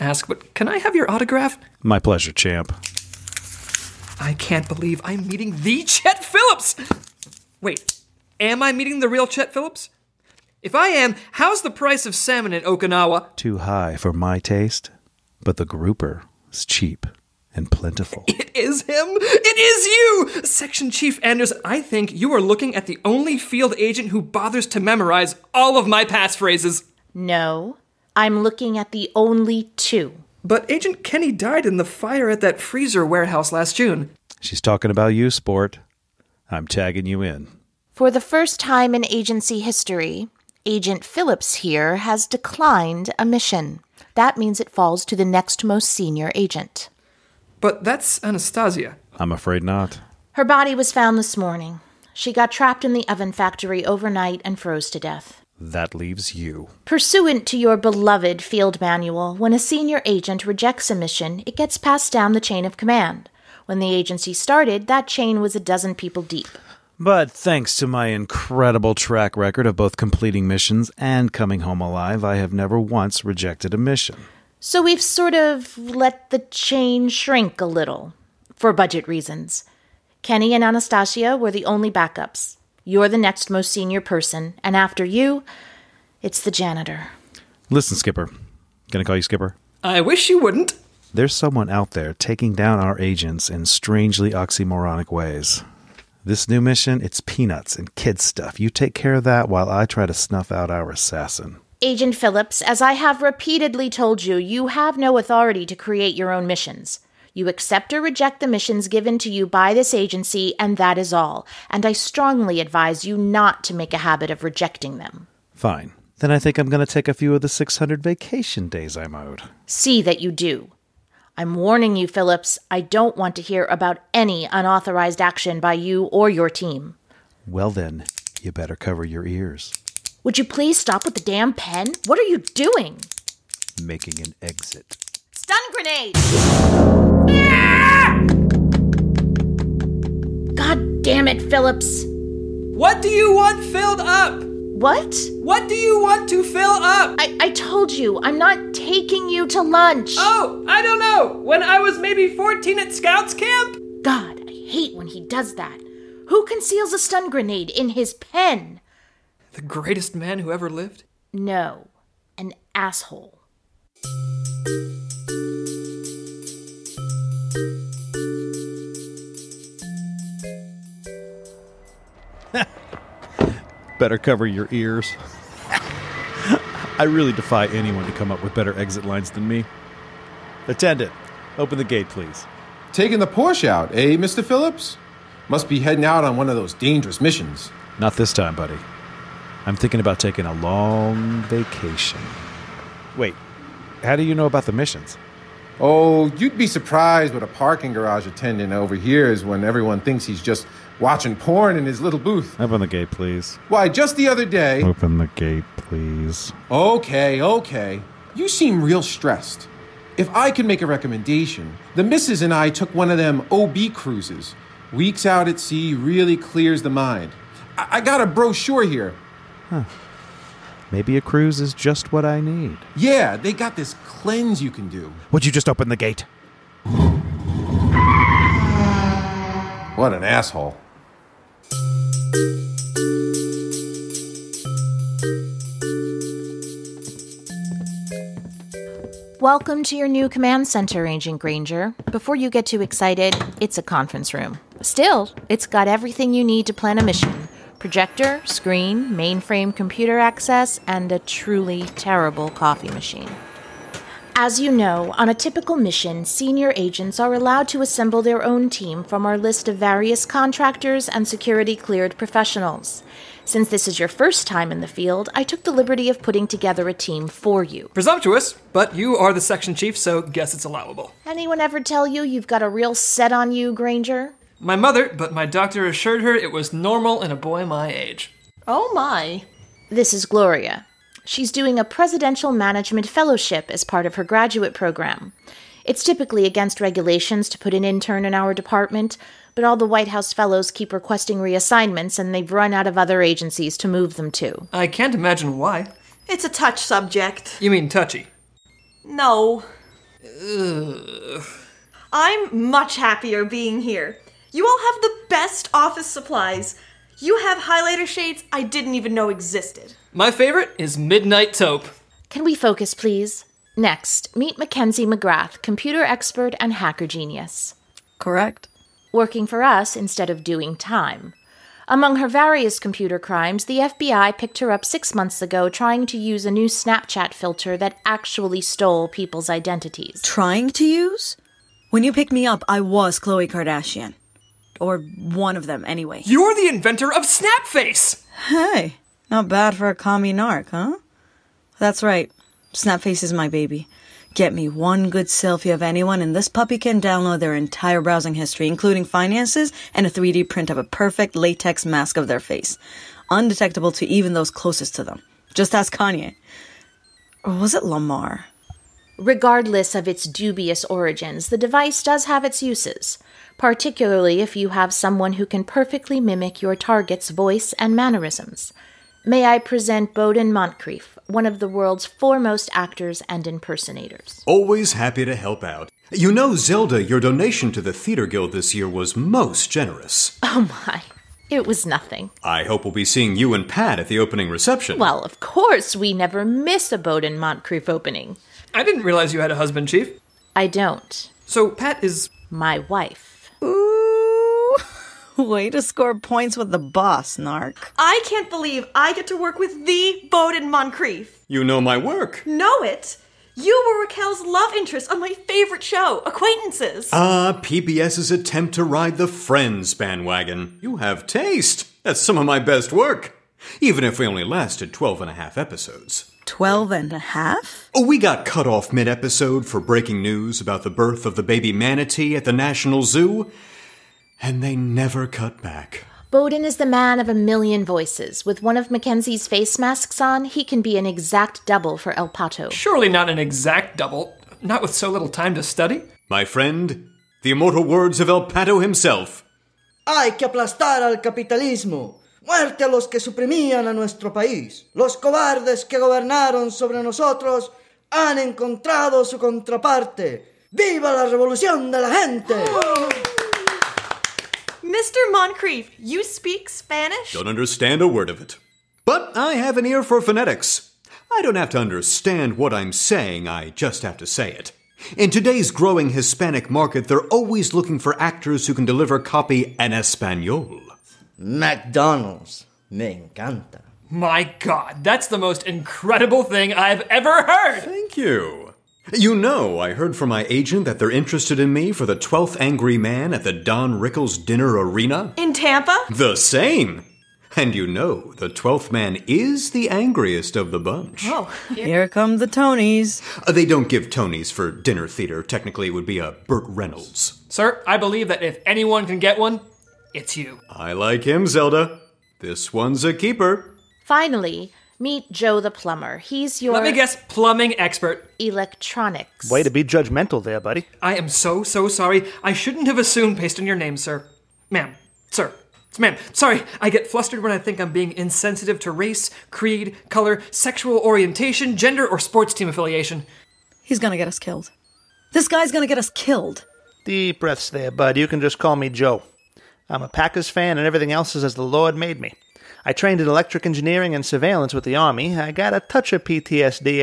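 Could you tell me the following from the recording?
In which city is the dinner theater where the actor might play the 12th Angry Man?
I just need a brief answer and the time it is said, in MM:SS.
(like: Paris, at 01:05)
Tampa, at 08:05.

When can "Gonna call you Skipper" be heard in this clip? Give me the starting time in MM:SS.
01:28.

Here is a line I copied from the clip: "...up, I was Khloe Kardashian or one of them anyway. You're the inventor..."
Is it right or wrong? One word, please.
right.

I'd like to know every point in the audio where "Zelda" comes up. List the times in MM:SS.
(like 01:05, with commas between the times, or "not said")
06:16, 08:21.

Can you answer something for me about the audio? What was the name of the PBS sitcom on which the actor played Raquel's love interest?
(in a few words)
Acquaintances.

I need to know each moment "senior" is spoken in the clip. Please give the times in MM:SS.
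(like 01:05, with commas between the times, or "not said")
00:45, 00:59, 01:23, 04:16.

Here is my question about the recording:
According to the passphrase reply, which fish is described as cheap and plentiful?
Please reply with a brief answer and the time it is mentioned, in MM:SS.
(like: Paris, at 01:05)
Grouper, at 00:15.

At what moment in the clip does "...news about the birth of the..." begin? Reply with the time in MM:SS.
07:00.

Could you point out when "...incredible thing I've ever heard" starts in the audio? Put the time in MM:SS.
07:55.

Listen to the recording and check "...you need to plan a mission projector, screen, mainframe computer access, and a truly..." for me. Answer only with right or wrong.
right.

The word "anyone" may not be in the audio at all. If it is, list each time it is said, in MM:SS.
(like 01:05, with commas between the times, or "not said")
02:57, 04:31, 05:45, 08:18.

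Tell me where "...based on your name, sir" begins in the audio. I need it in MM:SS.
08:33.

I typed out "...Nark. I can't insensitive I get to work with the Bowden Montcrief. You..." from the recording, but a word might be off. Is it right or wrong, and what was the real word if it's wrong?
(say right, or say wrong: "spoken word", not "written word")
wrong: "believe", not "insensitive".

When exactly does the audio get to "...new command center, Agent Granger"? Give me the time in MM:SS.
04:00.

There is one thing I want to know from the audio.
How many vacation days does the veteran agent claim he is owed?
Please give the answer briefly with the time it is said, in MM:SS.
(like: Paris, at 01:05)
600, at 01:57.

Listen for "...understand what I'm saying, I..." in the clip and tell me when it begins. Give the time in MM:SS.
07:41.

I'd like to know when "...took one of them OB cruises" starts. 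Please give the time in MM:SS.
03:32.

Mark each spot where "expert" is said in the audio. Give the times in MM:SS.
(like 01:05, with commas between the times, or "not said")
05:16, 08:27.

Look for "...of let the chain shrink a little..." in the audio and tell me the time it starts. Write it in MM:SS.
01:15.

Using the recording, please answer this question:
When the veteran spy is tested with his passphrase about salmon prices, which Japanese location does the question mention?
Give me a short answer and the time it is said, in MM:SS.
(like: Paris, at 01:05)
Okinawa, at 00:12.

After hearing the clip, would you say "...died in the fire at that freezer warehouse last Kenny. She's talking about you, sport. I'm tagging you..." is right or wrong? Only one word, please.
wrong.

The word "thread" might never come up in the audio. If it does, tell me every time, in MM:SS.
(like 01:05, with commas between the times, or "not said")
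not said.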